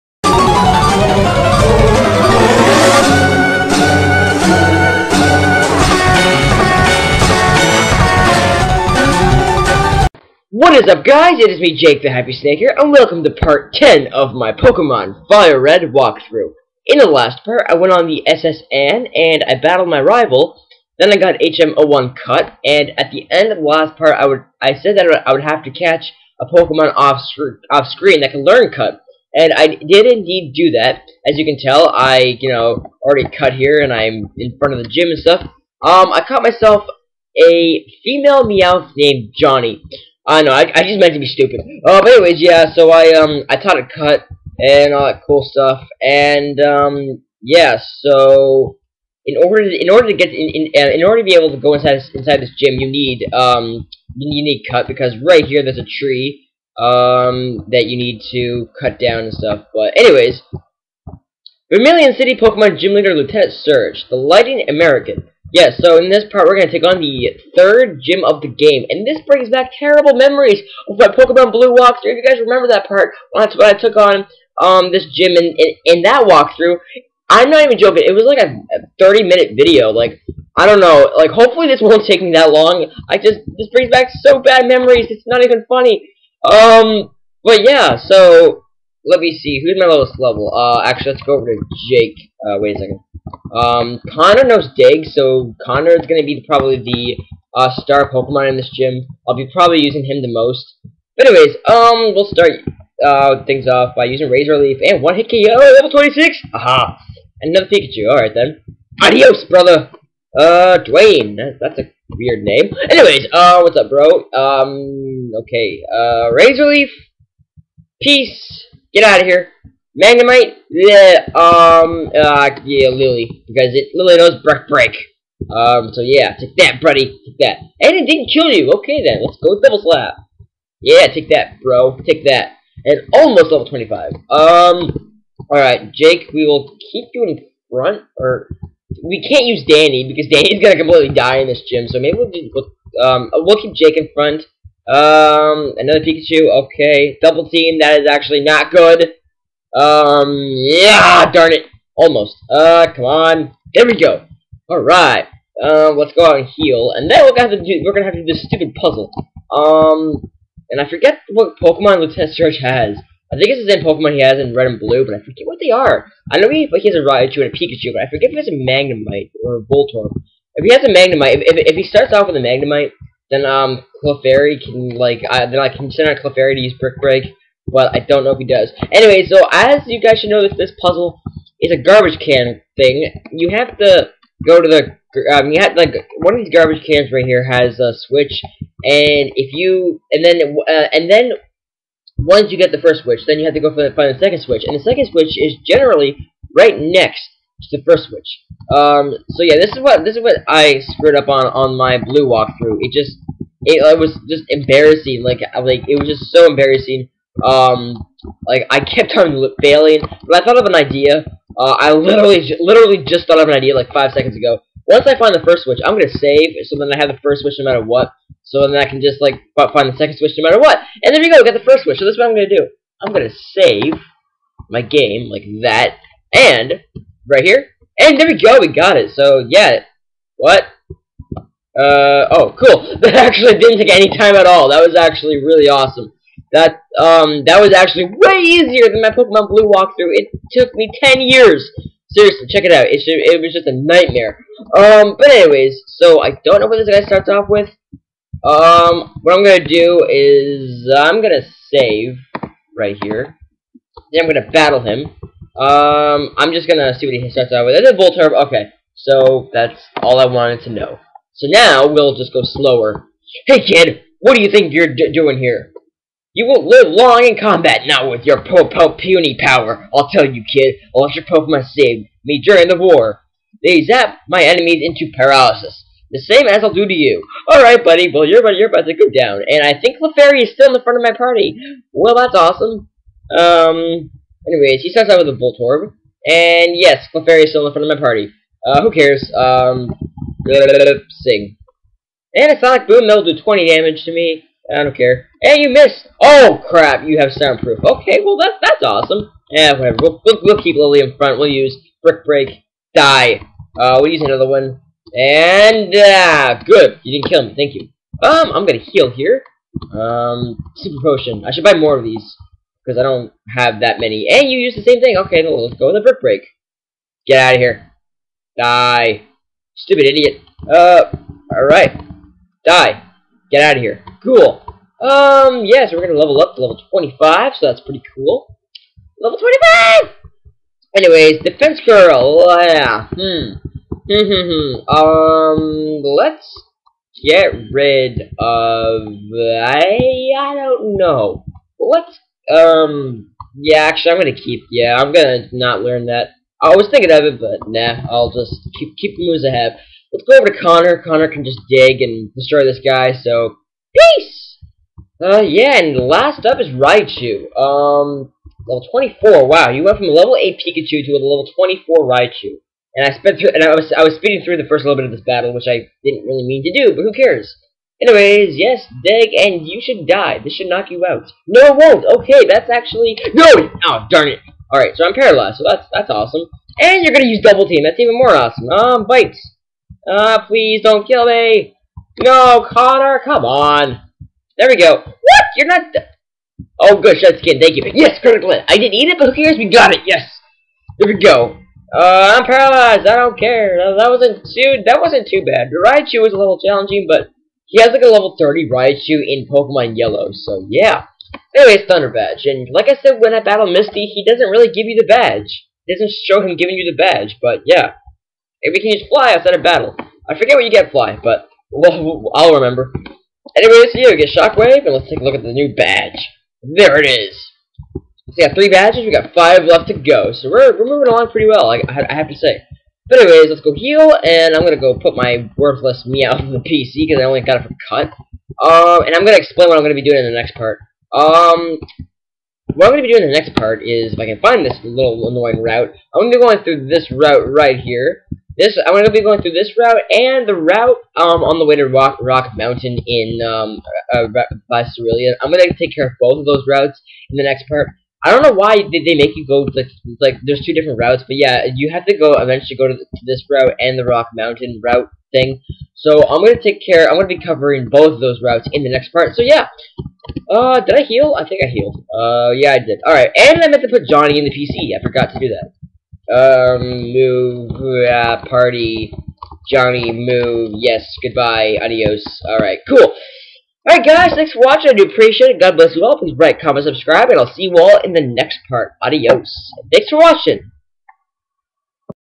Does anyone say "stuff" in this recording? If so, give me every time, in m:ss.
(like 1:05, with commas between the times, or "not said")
0:35, 0:45, 0:59.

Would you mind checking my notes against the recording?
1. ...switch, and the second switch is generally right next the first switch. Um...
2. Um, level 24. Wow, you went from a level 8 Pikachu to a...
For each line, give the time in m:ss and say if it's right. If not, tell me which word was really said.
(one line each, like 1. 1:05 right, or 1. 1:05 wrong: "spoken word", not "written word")
1. 3:14 right
2. 5:57 right.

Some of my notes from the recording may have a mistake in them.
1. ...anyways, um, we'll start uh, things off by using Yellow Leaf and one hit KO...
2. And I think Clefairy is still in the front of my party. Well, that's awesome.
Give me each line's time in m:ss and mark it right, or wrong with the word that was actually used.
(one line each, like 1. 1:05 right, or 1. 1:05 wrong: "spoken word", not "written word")
1. 1:41 wrong: "Razor", not "Yellow"
2. 4:39 right.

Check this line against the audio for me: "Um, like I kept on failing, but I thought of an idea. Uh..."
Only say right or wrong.
right.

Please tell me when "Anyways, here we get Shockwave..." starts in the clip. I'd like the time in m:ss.
6:53.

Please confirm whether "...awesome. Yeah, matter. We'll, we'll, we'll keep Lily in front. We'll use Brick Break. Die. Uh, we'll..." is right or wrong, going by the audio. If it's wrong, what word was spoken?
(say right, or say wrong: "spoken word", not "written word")
wrong: "whatever", not "matter".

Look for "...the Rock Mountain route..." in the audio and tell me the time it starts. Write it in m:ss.
7:33.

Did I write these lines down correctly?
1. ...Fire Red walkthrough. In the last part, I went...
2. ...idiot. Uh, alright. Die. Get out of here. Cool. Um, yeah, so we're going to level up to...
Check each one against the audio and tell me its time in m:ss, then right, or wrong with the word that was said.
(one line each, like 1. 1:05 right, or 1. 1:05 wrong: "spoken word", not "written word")
1. 0:15 right
2. 5:20 right.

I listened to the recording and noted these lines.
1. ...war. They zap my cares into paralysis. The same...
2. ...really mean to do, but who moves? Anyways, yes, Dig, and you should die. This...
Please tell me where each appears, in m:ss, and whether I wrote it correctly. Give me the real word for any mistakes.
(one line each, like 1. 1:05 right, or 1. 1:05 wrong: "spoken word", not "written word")
1. 4:32 wrong: "enemies", not "cares"
2. 6:06 wrong: "cares", not "moves".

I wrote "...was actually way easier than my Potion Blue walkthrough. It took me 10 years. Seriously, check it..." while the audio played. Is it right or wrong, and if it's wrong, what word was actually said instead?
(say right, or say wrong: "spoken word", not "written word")
wrong: "Pokemon", not "Potion".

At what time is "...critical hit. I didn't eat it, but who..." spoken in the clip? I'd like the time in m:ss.
6:28.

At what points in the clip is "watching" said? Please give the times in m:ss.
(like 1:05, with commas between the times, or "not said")
7:54, 8:00.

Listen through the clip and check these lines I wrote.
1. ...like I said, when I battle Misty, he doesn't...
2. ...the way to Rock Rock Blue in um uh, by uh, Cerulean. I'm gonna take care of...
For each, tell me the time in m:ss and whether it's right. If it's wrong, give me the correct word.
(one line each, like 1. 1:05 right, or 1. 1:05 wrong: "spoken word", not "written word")
1. 6:42 right
2. 7:21 wrong: "Mountain", not "Blue".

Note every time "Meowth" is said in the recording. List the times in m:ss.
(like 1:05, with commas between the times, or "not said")
0:38, 7:06.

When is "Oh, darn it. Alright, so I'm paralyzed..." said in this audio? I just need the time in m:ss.
6:13.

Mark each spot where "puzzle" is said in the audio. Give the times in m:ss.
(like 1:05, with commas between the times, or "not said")
2:38, 3:00.